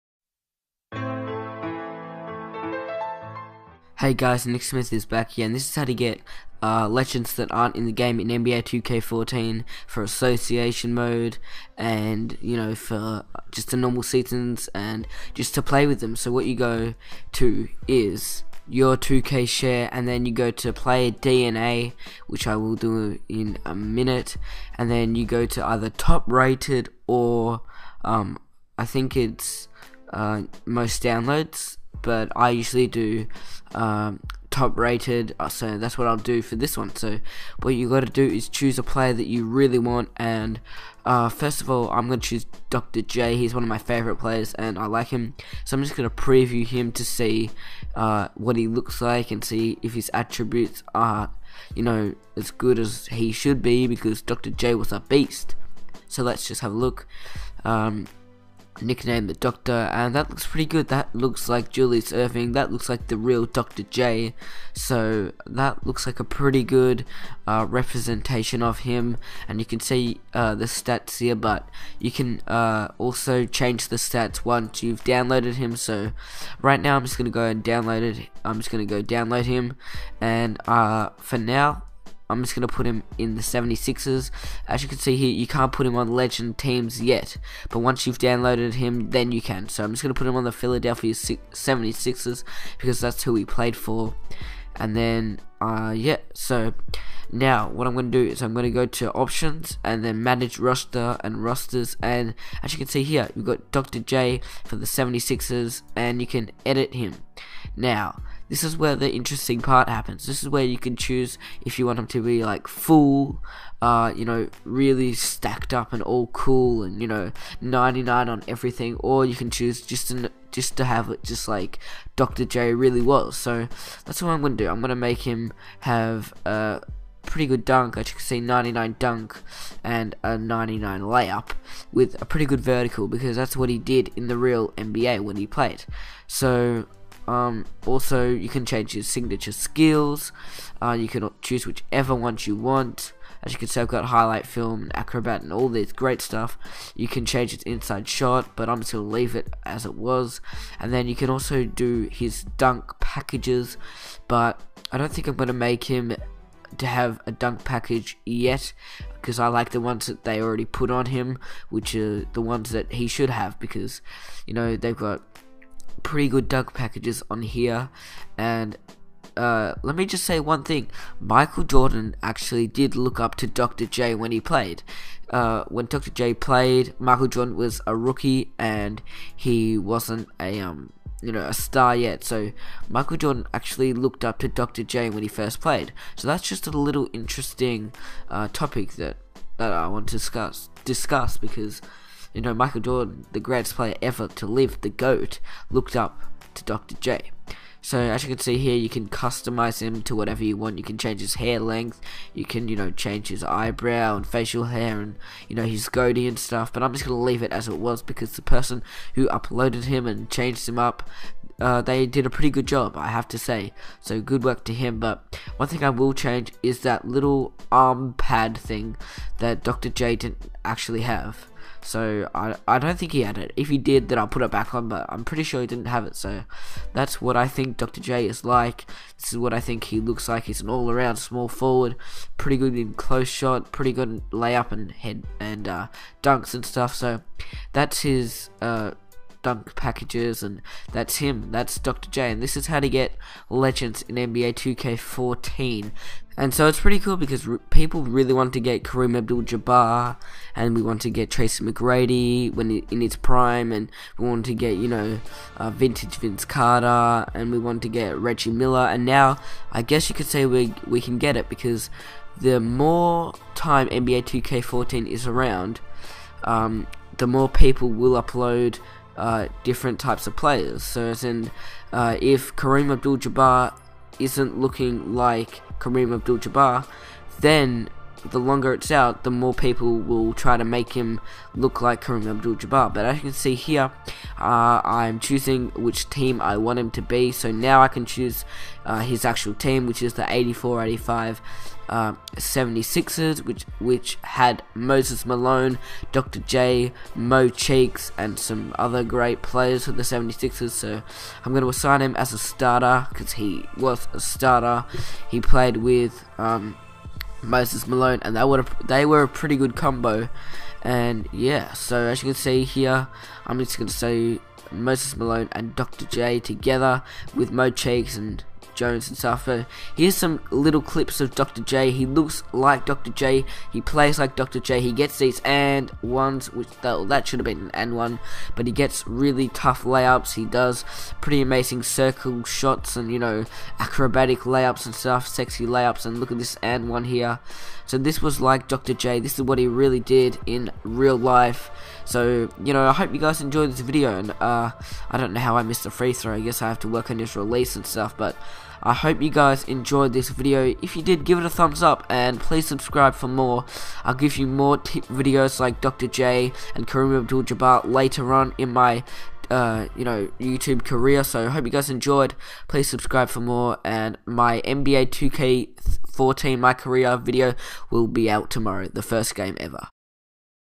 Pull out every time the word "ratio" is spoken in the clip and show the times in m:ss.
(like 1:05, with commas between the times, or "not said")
not said.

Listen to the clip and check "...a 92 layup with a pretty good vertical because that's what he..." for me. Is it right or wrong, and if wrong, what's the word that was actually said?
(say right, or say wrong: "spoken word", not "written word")
wrong: "99", not "92".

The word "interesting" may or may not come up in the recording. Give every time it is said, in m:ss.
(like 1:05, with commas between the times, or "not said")
1:49, 3:07.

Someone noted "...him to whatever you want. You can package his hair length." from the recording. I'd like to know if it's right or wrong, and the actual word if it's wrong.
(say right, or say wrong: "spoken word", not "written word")
wrong: "change", not "package".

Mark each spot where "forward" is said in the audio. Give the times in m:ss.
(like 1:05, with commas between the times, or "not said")
3:51.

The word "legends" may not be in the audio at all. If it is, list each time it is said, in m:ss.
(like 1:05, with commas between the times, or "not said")
0:06, 1:26, 4:03.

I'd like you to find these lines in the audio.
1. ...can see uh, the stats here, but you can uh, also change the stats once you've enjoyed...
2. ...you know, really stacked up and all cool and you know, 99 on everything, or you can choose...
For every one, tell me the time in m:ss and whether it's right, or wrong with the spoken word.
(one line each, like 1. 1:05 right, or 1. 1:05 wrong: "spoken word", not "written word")
1. 1:09 wrong: "downloaded", not "enjoyed"
2. 1:54 right.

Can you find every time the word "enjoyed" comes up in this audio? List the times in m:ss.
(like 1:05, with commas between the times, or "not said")
5:43, 5:49, 6:01.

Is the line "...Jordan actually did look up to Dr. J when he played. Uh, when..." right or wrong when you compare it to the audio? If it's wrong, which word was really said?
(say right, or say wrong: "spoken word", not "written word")
right.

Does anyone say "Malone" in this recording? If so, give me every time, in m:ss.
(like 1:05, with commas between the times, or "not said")
4:55, 5:07, 5:15.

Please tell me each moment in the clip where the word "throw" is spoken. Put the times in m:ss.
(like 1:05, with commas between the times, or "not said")
5:46.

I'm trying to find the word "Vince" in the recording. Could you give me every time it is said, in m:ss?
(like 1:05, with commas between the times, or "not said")
4:16.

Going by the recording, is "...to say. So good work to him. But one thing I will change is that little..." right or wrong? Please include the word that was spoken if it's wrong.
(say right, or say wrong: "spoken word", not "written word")
right.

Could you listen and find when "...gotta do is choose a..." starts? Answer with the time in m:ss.
0:37.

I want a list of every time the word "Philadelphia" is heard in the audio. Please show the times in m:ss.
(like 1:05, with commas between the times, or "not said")
1:30.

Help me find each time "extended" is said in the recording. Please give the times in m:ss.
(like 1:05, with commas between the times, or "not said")
not said.